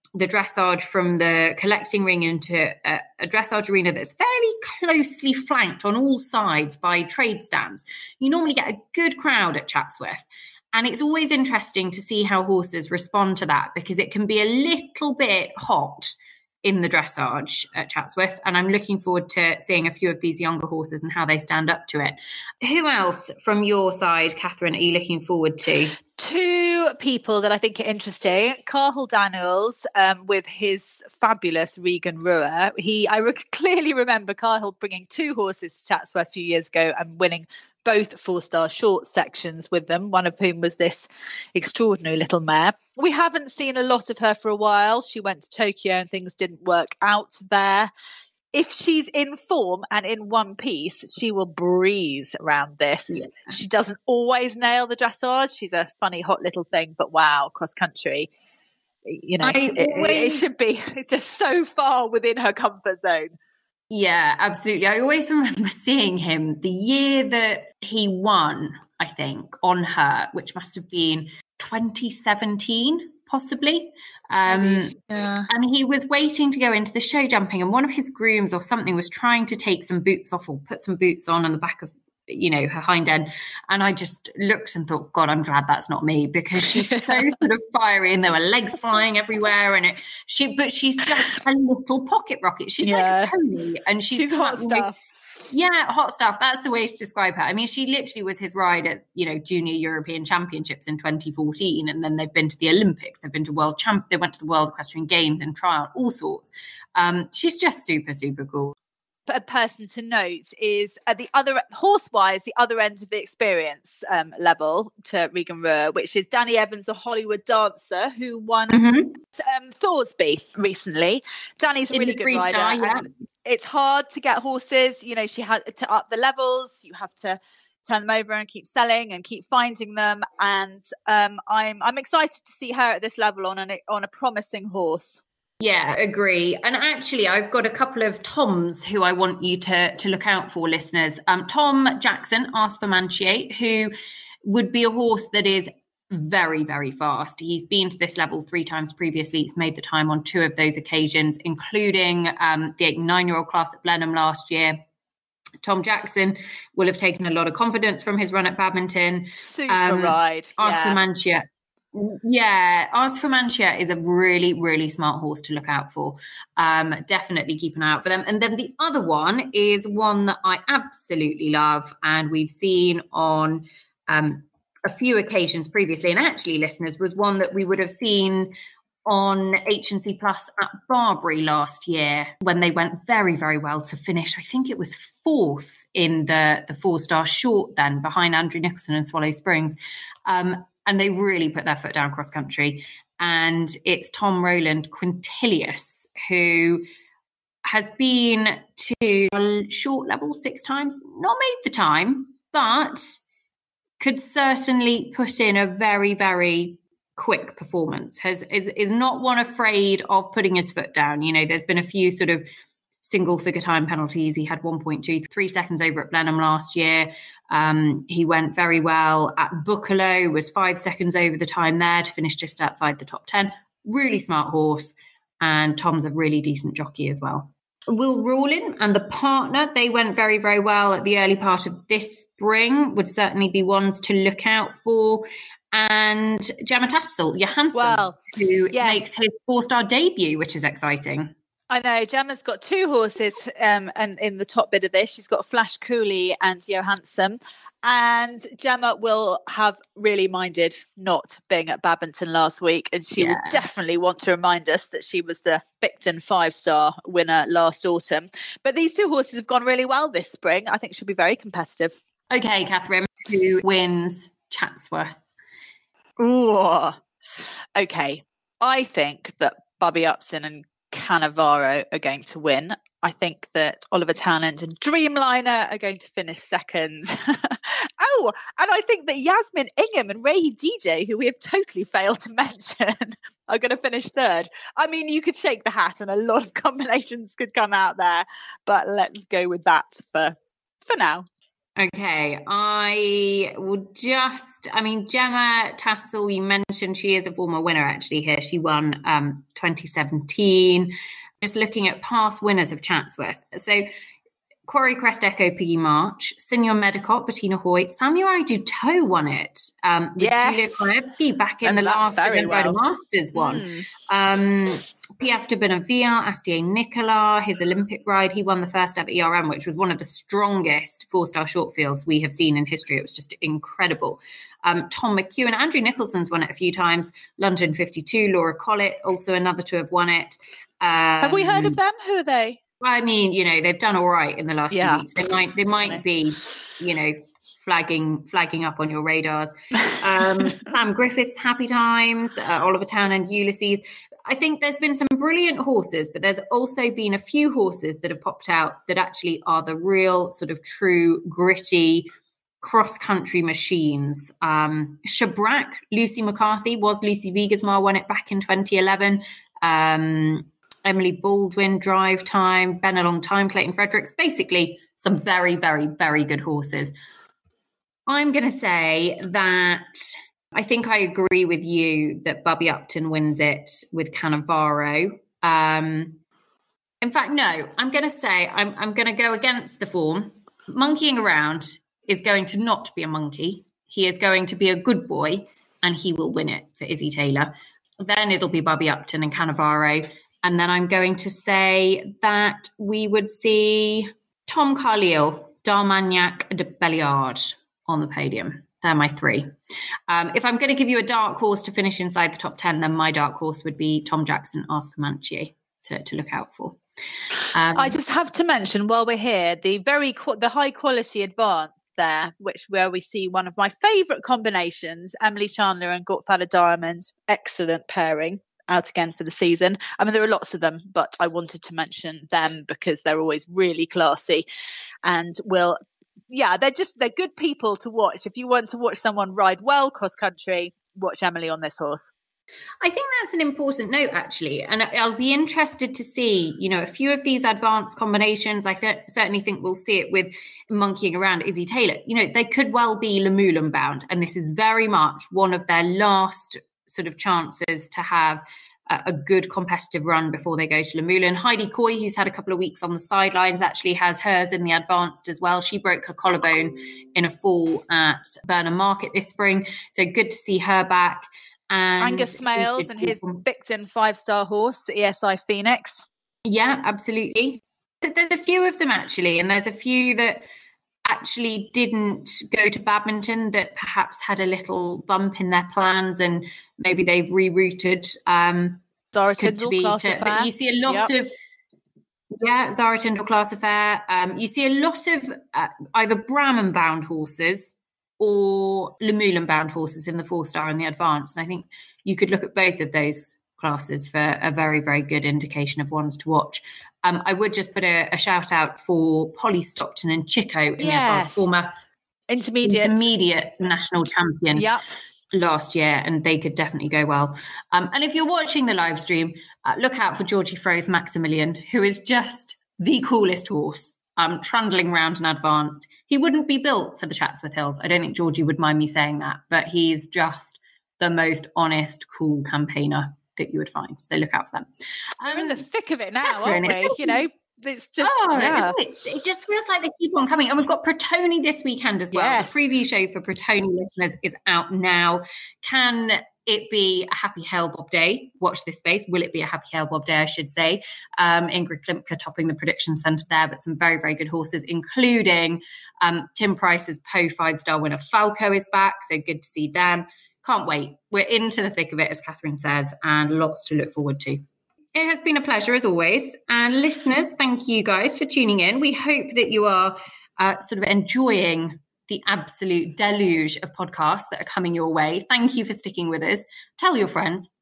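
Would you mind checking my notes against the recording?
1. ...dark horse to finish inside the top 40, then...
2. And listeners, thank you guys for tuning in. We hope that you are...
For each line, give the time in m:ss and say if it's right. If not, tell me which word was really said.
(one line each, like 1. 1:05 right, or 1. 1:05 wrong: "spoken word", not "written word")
1. 6:41 wrong: "10", not "40"
2. 9:16 right.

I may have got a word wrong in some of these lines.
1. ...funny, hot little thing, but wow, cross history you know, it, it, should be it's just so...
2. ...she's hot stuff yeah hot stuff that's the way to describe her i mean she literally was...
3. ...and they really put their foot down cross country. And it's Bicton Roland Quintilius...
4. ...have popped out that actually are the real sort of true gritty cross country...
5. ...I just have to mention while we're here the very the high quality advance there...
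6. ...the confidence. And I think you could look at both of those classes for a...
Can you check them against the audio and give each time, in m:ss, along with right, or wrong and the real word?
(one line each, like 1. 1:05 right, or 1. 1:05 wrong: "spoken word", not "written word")
1. 0:56 wrong: "country", not "history"
2. 1:34 right
3. 3:10 wrong: "Tom", not "Bicton"
4. 5:48 right
5. 6:47 right
6. 8:10 wrong: "advance", not "confidence".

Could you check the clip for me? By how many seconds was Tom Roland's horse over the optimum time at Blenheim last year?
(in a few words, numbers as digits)
1.23.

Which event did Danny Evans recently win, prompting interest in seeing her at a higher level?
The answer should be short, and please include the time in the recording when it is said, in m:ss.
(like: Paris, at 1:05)
Thoresby, at 1:59.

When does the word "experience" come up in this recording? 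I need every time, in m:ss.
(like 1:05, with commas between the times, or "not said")
1:53.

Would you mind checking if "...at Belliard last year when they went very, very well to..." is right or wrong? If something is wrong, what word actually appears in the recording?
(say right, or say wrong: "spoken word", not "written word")
wrong: "Barbury", not "Belliard".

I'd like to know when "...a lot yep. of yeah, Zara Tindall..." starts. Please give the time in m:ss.
8:00.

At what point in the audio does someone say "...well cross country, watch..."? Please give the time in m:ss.
7:09.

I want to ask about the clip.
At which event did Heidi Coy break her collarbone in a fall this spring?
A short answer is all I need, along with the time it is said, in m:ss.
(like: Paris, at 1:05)
Burnham Market, at 7:38.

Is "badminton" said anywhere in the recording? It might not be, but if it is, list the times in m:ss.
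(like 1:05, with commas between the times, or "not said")
2:38, 4:11, 7:52.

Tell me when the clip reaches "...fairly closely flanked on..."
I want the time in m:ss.
0:04.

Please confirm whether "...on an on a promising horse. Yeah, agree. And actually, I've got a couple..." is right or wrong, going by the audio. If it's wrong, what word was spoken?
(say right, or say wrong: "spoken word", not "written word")
right.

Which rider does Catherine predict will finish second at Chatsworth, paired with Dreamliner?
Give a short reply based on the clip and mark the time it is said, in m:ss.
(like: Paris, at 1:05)
Oliver Townend, at 4:33.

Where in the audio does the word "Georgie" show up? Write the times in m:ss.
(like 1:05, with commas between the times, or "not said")
8:30, 8:38.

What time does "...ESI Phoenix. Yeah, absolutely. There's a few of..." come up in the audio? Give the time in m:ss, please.
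7:44.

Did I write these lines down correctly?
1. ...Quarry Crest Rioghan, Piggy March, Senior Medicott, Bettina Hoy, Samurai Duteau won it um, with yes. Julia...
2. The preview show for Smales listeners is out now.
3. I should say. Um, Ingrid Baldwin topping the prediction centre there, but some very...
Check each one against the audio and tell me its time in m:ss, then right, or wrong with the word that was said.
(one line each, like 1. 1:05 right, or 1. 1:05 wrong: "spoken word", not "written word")
1. 5:04 wrong: "Echo", not "Rioghan"
2. 8:52 wrong: "Pratoni", not "Smales"
3. 9:00 wrong: "Klimke", not "Baldwin".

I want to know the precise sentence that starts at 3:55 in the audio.
And Gemma Tattersall, Johansson, well, who yes.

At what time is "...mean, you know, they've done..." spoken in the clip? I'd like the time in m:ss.
5:33.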